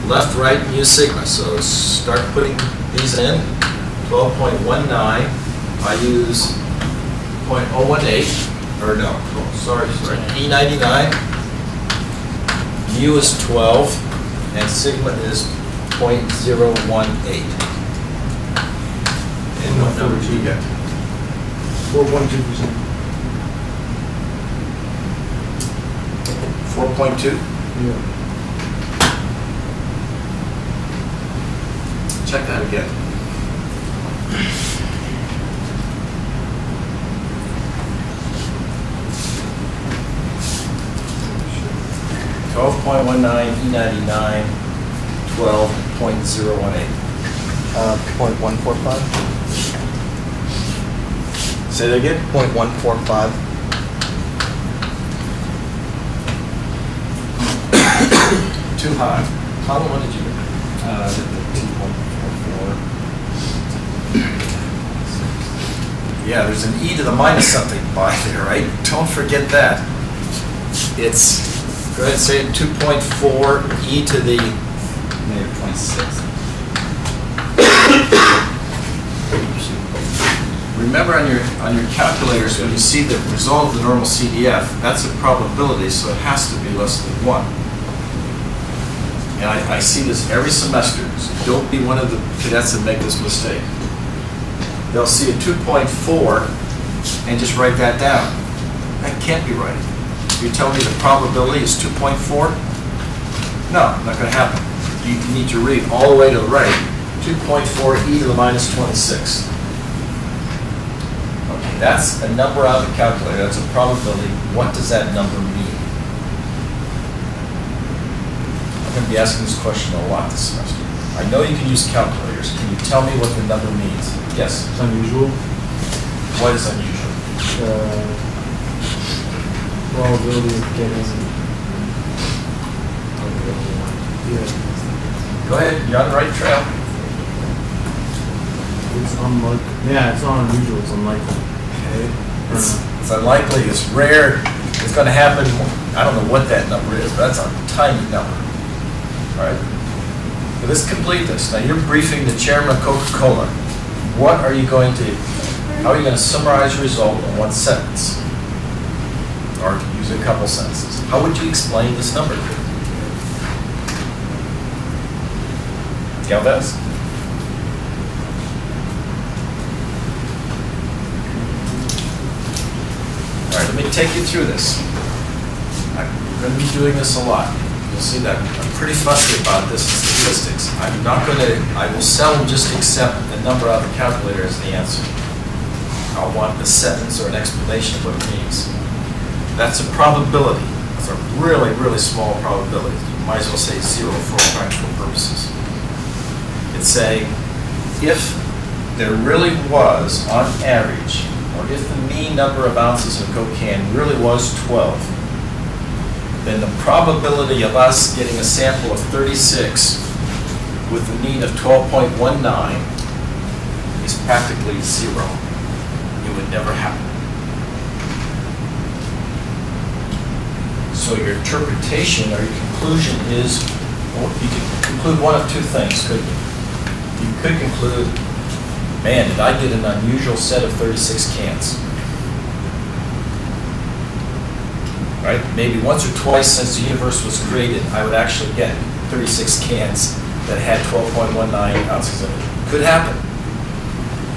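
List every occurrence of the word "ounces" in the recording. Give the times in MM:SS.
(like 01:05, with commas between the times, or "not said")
03:22, 04:01.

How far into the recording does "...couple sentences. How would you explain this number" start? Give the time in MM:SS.
02:40.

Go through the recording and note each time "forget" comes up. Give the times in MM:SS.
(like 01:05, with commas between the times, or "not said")
01:09.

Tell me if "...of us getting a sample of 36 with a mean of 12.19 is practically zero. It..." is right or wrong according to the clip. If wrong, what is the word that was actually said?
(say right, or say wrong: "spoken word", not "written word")
right.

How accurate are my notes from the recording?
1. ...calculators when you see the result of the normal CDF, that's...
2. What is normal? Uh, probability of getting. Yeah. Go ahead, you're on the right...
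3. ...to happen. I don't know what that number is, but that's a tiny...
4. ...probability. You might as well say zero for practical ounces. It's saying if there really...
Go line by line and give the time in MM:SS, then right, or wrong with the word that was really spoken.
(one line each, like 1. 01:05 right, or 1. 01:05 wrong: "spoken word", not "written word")
1. 01:21 right
2. 02:06 wrong: "unusual", not "normal"
3. 02:25 right
4. 03:12 wrong: "purposes", not "ounces".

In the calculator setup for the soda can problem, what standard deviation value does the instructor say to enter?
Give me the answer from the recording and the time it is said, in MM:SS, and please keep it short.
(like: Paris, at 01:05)
0.018, at 00:14.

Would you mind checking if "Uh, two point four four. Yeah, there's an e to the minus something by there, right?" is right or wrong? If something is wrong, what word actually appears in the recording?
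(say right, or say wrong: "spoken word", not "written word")
right.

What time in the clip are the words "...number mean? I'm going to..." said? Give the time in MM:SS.
01:55.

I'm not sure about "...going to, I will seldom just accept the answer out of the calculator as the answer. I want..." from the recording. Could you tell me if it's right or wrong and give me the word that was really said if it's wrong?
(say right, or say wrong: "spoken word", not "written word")
wrong: "number", not "answer".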